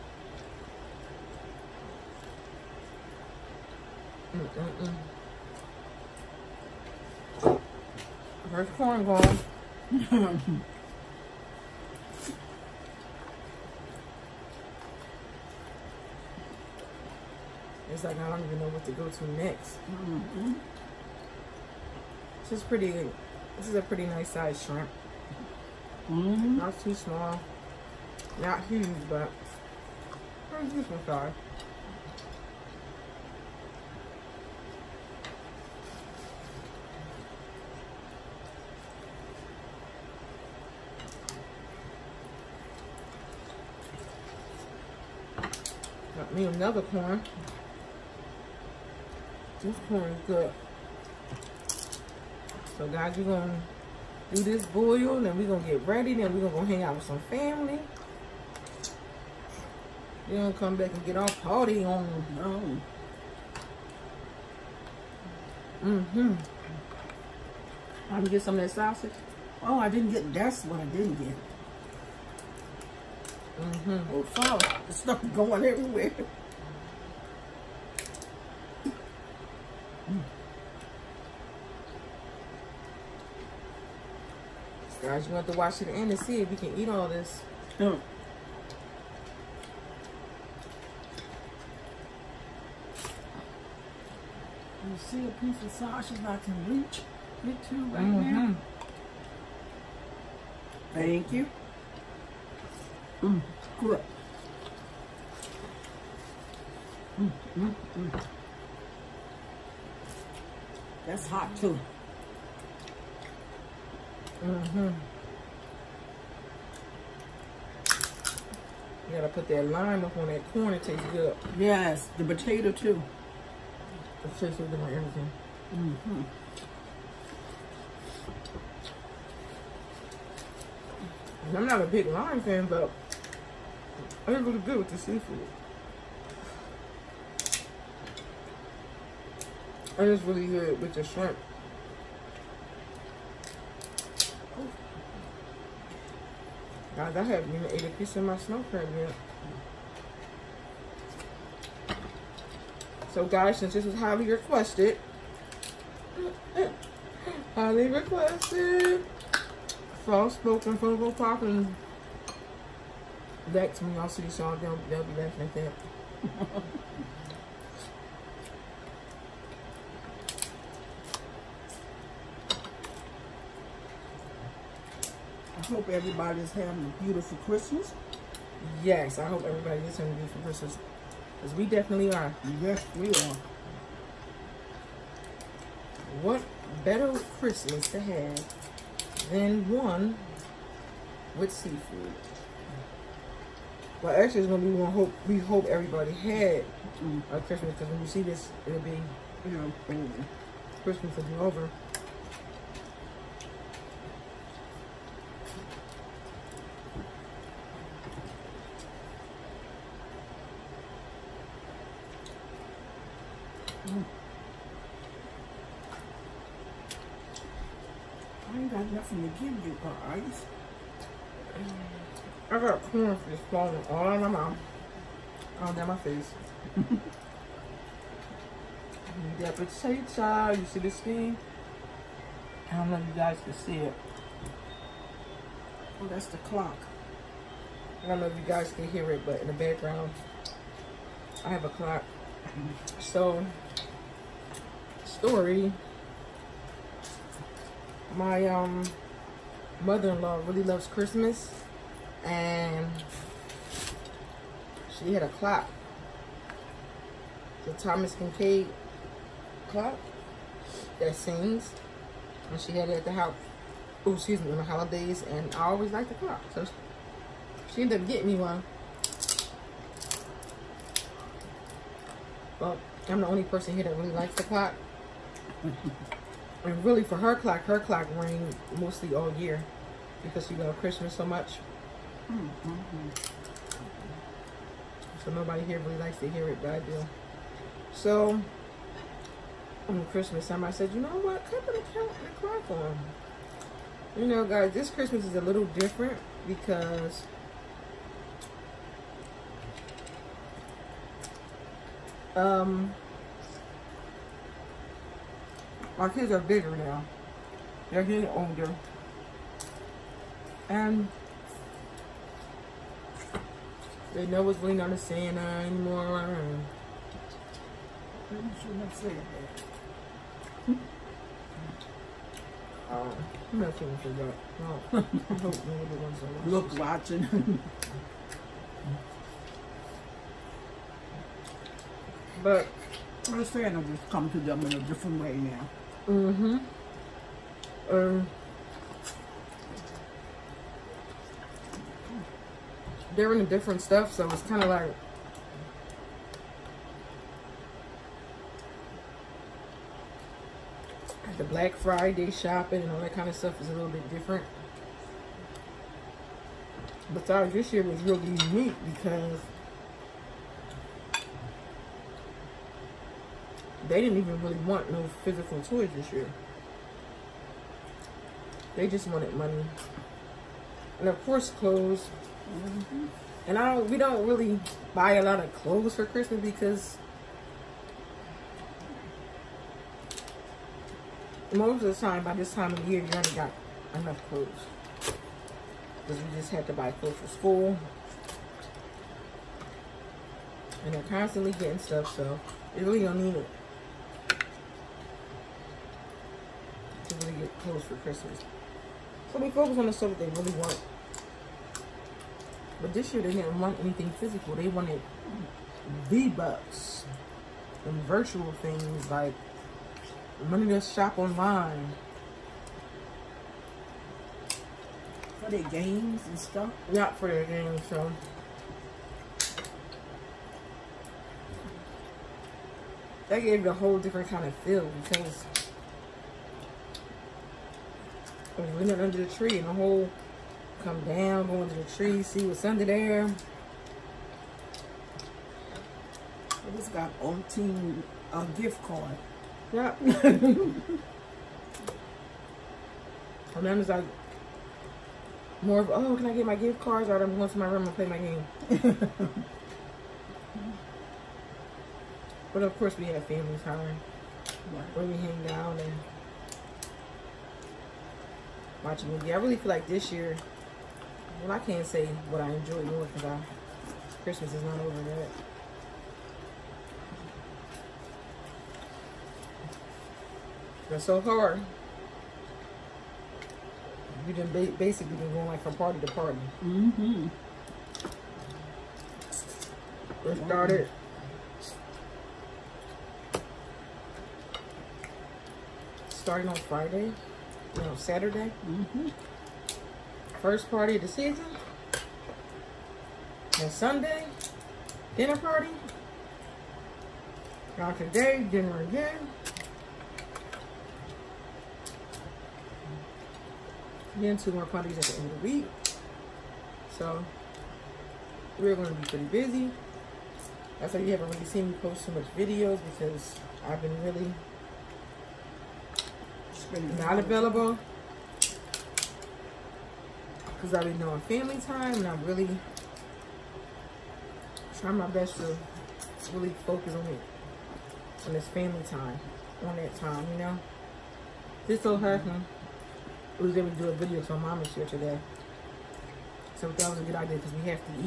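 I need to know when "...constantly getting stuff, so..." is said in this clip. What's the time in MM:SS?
06:31.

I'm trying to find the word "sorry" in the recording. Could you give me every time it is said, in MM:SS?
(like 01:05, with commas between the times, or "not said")
01:14, 05:57.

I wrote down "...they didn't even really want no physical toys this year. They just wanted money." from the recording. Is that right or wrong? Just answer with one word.
right.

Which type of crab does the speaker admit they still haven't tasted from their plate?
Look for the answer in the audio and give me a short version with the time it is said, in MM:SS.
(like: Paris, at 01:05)
snow crab, at 02:28.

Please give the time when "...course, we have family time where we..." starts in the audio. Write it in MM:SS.
07:32.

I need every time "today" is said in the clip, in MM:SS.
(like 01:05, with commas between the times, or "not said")
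08:17, 08:54.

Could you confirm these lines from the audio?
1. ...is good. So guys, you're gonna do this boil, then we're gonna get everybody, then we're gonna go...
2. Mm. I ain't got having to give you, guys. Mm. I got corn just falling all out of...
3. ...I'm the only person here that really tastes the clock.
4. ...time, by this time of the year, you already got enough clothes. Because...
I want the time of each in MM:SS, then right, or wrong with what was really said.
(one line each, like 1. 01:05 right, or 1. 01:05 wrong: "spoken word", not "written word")
1. 00:50 wrong: "ready", not "everybody"
2. 03:33 wrong: "nothing", not "having"
3. 04:33 wrong: "likes", not "tastes"
4. 06:21 right.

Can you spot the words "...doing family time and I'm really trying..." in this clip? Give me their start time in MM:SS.
08:40.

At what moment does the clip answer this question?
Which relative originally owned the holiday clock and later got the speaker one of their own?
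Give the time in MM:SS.
04:09.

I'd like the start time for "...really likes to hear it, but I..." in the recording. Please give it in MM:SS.
04:45.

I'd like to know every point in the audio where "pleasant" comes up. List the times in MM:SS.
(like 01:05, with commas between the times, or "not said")
not said.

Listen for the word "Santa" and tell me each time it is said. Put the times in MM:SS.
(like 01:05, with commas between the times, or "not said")
05:14, 05:33.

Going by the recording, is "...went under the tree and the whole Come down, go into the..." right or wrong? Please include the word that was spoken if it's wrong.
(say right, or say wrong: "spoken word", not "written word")
right.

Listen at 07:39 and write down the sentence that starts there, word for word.
I really feel like this year well, I can't say what I enjoy more because Christmas is not over yet.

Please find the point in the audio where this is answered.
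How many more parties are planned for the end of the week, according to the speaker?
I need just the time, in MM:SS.
08:24.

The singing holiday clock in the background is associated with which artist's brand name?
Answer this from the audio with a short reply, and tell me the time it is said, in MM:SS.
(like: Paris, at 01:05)
Thomas Kinkade, at 04:17.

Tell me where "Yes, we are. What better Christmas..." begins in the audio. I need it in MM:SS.
03:02.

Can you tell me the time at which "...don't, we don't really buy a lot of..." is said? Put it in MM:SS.
06:13.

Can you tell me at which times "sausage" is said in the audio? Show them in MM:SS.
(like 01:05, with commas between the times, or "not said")
01:08, 01:35.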